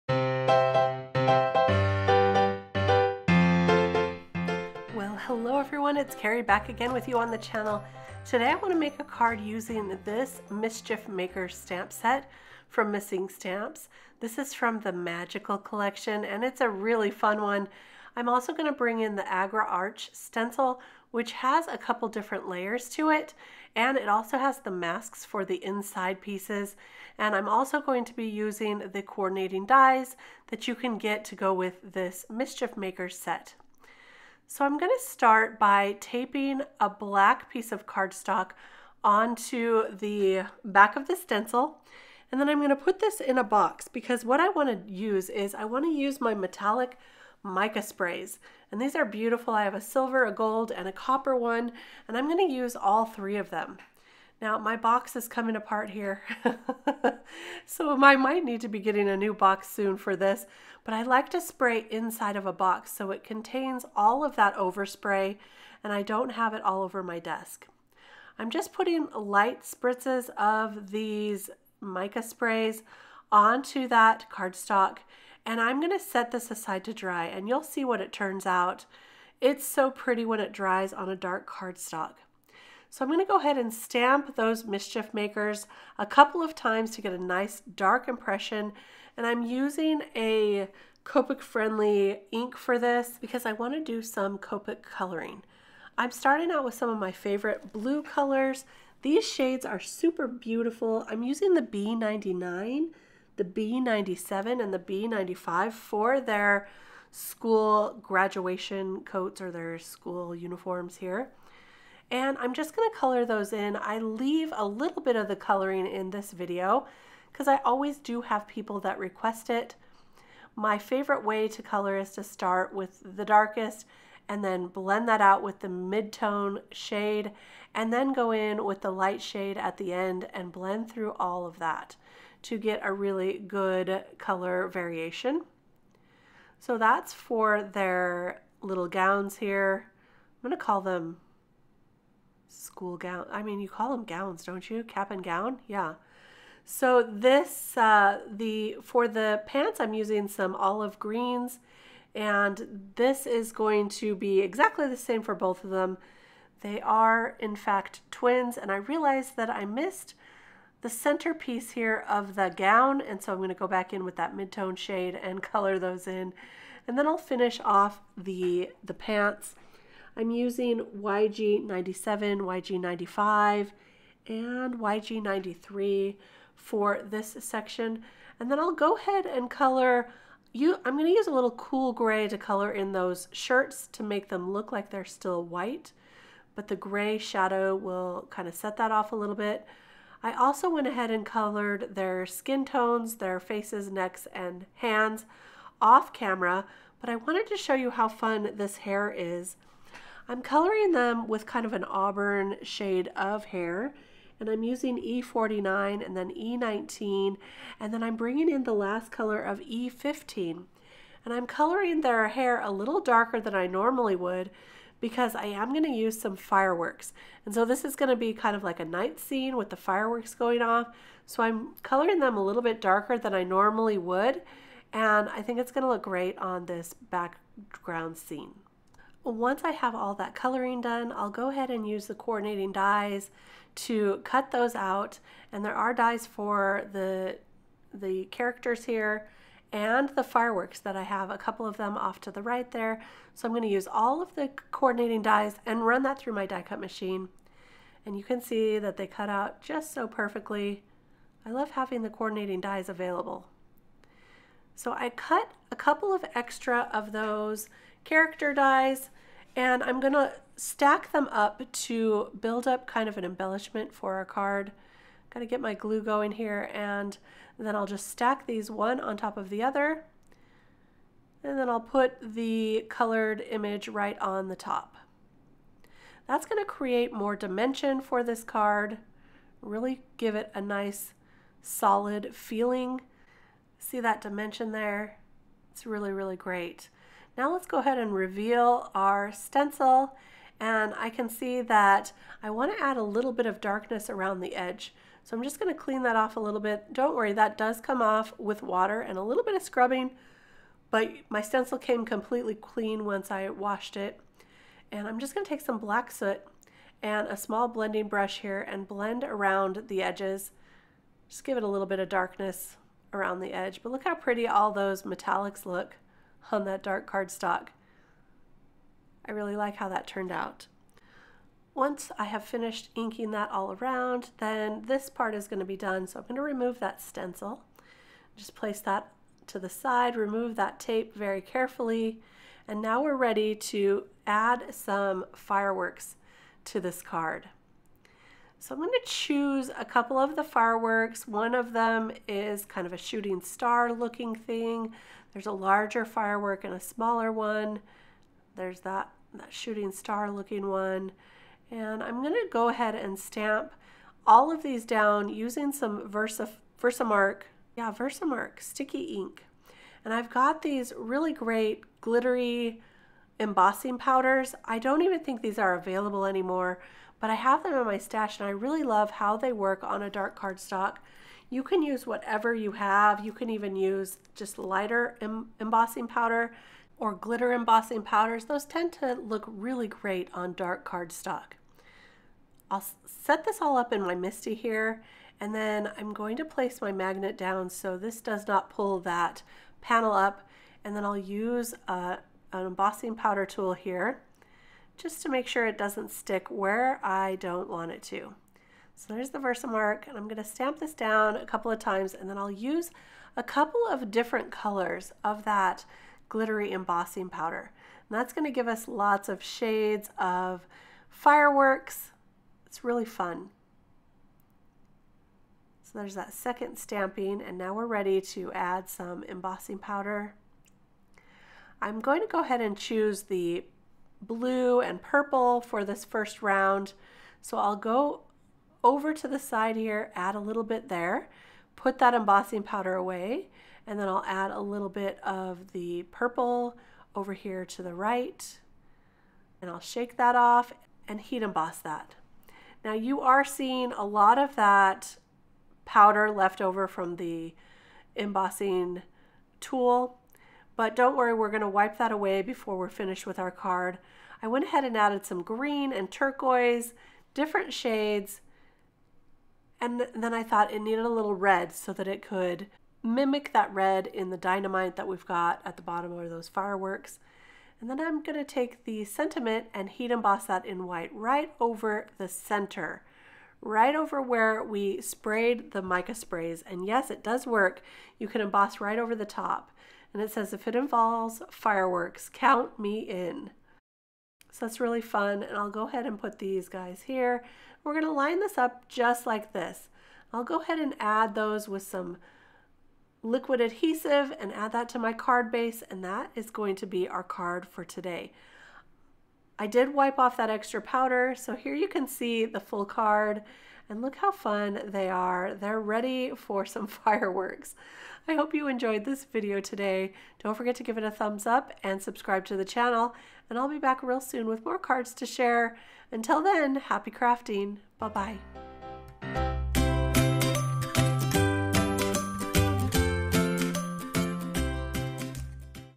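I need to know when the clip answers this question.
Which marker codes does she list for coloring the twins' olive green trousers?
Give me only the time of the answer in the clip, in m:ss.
2:50.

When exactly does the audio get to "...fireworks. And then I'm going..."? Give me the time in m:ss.
7:46.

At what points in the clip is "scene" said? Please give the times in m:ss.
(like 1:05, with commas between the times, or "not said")
3:39, 3:48.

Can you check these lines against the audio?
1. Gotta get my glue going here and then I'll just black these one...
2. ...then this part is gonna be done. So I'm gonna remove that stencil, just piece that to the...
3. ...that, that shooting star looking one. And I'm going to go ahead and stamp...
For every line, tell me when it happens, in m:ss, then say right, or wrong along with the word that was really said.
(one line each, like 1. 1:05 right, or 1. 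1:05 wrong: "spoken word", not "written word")
1. 4:25 wrong: "stack", not "black"
2. 5:24 wrong: "place", not "piece"
3. 5:48 right.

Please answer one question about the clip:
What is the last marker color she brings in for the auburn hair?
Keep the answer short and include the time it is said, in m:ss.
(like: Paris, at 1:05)
E15, at 3:29.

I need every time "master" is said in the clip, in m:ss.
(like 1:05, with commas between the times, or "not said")
not said.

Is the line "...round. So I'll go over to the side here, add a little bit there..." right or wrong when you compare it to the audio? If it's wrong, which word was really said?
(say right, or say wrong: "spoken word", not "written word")
right.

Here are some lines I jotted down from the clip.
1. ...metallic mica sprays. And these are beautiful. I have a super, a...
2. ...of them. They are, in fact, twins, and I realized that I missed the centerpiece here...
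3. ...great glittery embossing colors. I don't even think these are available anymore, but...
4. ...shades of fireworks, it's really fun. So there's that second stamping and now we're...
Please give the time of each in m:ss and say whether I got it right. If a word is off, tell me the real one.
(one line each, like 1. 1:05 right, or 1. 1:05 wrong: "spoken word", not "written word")
1. 0:46 wrong: "silver", not "super"
2. 2:35 right
3. 6:01 wrong: "powders", not "colors"
4. 6:49 right.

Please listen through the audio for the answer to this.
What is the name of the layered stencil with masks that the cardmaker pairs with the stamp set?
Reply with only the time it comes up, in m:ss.
0:19.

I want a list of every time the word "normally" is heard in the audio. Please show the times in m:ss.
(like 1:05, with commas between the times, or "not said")
3:33, 3:43.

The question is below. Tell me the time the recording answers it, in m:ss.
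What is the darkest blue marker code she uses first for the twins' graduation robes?
1:41.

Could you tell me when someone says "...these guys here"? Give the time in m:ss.
8:06.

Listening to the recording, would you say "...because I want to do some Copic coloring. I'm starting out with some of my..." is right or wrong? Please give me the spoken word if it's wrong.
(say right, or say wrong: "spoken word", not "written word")
right.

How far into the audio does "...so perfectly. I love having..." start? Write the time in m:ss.
4:09.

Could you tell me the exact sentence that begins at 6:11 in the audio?
You can use whatever you have.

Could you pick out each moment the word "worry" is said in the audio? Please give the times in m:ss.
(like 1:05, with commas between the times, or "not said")
4:57, 7:31.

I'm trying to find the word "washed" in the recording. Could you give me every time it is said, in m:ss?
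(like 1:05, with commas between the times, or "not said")
5:03.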